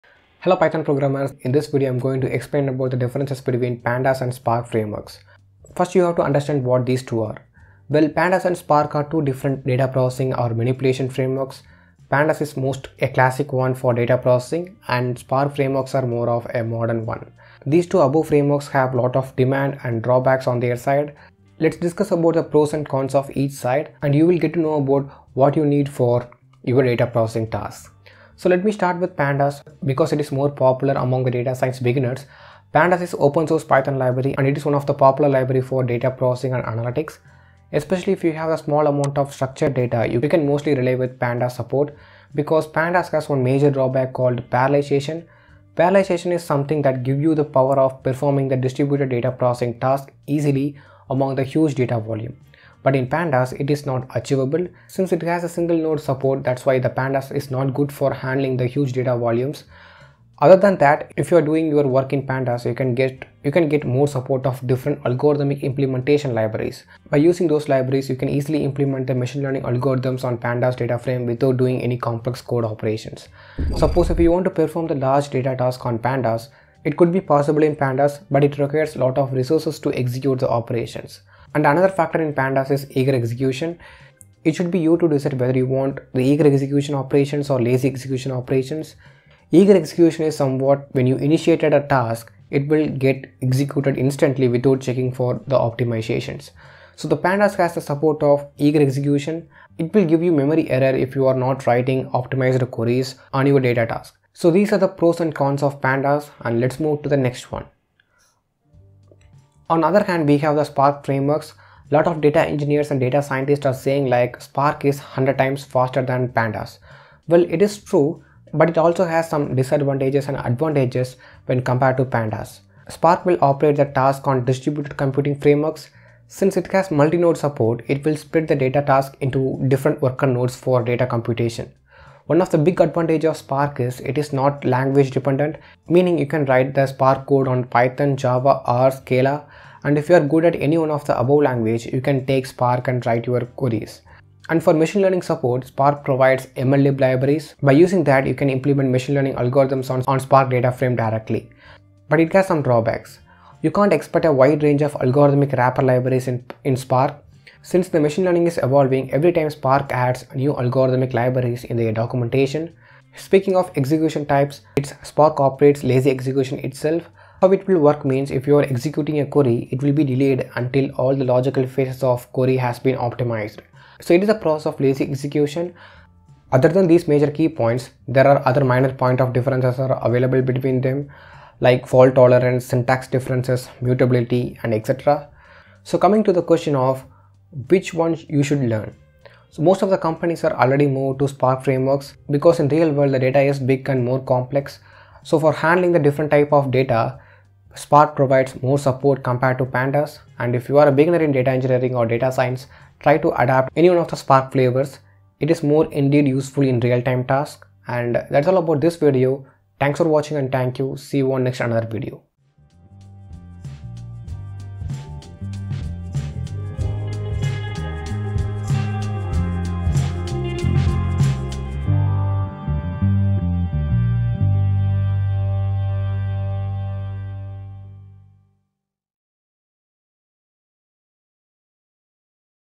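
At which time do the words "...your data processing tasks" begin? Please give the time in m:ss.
0:26.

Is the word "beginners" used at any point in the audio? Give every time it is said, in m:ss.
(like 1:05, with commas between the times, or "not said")
0:31, 3:20.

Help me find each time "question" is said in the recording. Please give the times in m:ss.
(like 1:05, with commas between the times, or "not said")
3:06.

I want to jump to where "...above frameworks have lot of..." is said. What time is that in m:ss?
0:17.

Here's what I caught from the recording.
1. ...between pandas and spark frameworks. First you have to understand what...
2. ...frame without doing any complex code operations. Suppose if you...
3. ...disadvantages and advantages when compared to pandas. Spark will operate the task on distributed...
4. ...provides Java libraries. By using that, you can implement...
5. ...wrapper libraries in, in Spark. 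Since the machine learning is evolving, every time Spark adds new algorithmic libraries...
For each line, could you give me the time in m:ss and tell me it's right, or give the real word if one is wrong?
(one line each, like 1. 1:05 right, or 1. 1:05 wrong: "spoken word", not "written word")
1. 0:03 right
2. 1:10 right
3. 1:59 right
4. 2:26 wrong: "MLlib", not "Java"
5. 2:35 right.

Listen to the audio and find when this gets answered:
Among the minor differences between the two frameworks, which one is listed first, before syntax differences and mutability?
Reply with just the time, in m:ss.
3:01.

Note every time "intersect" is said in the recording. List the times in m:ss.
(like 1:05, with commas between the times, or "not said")
not said.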